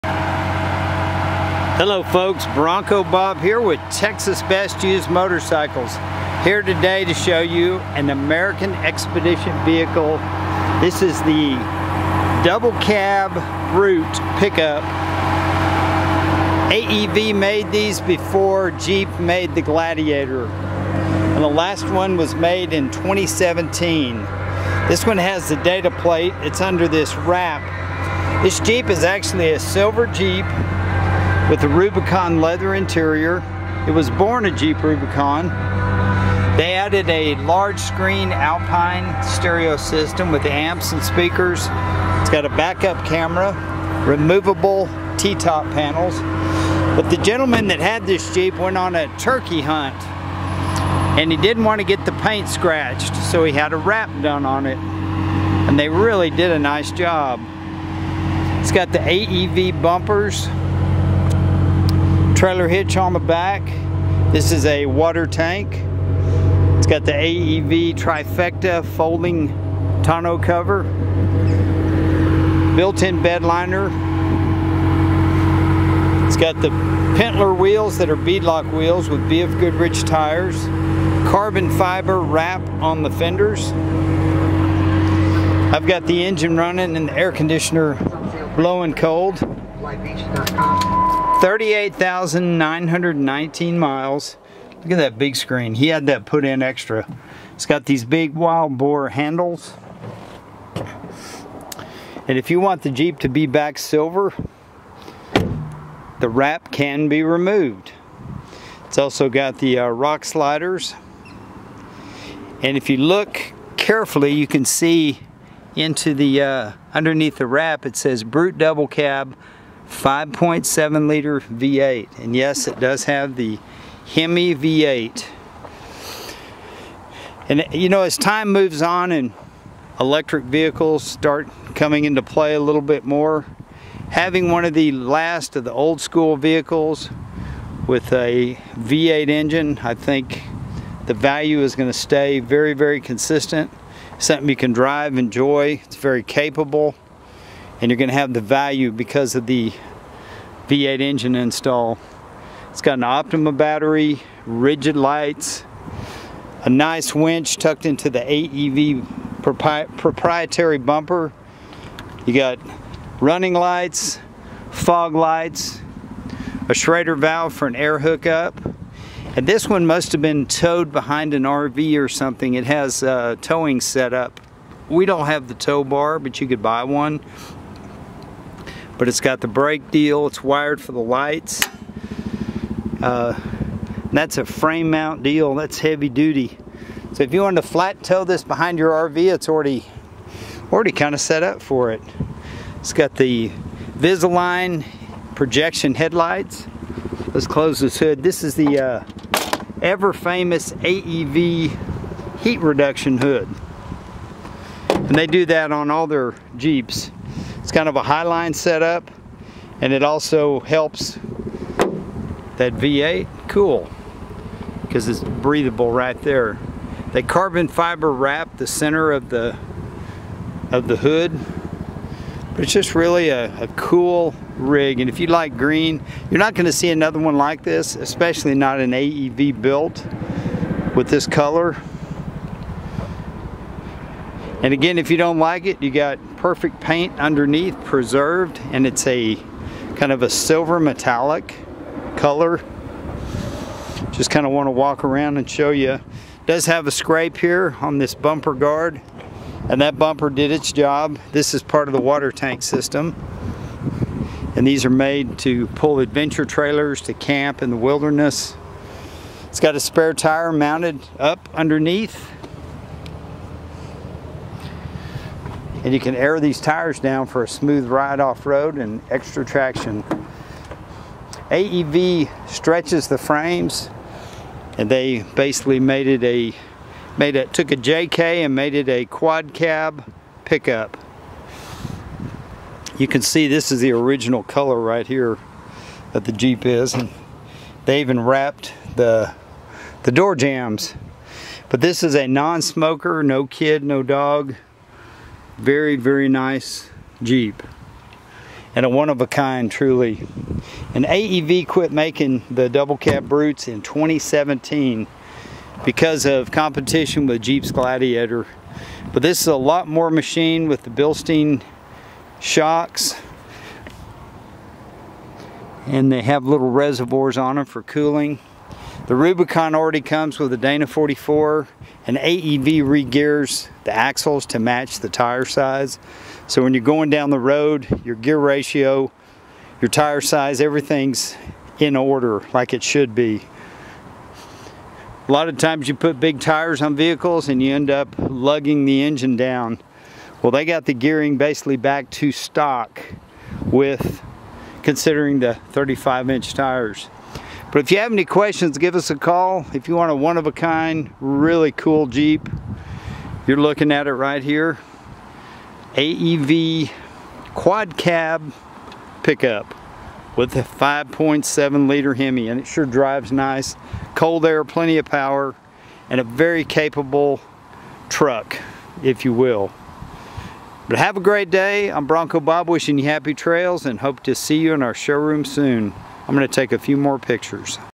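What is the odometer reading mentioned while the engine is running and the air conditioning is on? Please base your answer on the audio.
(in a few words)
38,919 miles.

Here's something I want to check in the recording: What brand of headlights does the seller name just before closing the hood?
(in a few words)
Visaline.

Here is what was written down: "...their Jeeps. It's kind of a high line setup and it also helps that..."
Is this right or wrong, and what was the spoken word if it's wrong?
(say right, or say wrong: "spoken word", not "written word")
right.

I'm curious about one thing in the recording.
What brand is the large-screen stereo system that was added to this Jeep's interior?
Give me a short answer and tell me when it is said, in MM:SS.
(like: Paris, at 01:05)
Alpine, at 00:38.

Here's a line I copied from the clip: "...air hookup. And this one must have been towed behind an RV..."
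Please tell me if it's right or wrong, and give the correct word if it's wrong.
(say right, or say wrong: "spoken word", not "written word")
right.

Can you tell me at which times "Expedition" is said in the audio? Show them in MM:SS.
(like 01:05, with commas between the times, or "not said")
00:08.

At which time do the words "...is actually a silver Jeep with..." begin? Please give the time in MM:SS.
00:28.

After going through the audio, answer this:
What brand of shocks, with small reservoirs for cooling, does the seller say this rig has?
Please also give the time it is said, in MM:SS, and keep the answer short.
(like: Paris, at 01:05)
Bilstein, at 05:10.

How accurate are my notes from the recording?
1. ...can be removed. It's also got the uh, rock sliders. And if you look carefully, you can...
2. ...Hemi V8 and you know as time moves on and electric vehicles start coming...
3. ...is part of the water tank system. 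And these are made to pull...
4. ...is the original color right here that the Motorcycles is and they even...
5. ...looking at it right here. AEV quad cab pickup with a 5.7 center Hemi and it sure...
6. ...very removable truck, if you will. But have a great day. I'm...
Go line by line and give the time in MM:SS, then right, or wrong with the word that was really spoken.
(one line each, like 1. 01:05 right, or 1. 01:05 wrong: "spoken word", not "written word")
1. 01:46 right
2. 02:04 right
3. 04:11 right
4. 04:43 wrong: "Jeep", not "Motorcycles"
5. 05:53 wrong: "liter", not "center"
6. 06:06 wrong: "capable", not "removable".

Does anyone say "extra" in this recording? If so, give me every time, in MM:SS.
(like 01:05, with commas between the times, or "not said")
01:36, 04:29.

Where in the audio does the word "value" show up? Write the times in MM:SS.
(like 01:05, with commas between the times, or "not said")
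02:21, 02:28.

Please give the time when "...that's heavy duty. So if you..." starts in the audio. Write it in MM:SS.
03:05.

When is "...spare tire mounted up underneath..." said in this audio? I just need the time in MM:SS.
04:19.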